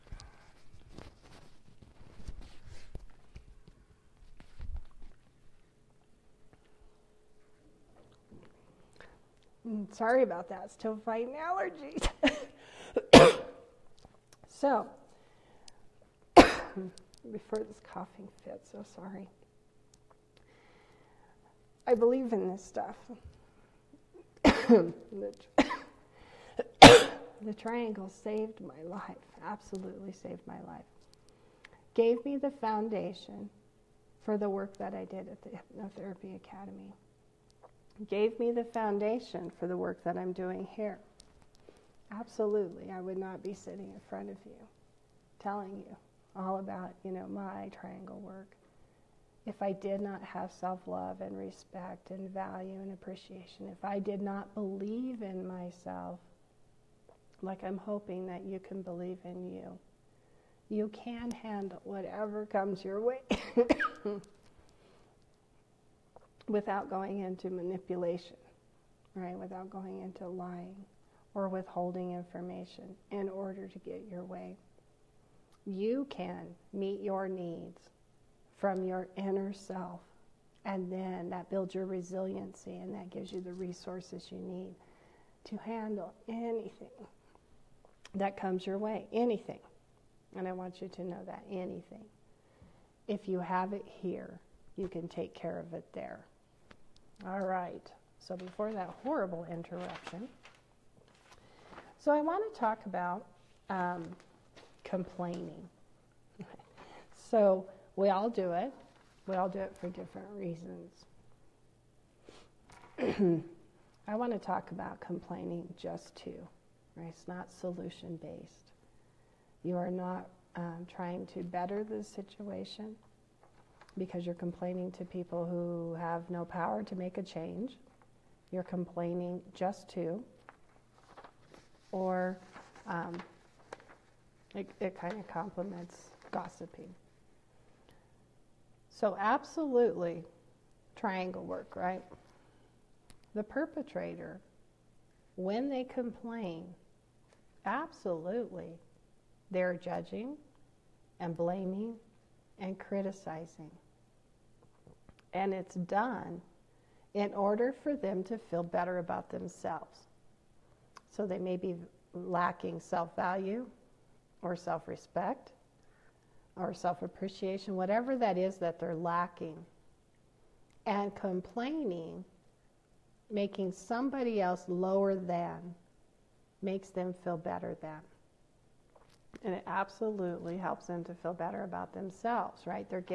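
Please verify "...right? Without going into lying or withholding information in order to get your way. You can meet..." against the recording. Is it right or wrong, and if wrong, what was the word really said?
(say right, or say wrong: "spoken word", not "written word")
right.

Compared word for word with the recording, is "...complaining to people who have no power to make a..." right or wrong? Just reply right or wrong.
right.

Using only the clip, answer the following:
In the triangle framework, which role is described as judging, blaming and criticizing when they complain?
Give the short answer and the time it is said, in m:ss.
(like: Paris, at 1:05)
The perpetrator, at 2:23.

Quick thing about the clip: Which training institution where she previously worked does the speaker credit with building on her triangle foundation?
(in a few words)
Hypnotherapy Academy.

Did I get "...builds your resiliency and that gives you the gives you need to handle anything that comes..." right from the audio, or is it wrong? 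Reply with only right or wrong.
wrong.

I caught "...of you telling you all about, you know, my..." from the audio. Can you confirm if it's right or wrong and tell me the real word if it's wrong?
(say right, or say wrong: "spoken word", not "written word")
right.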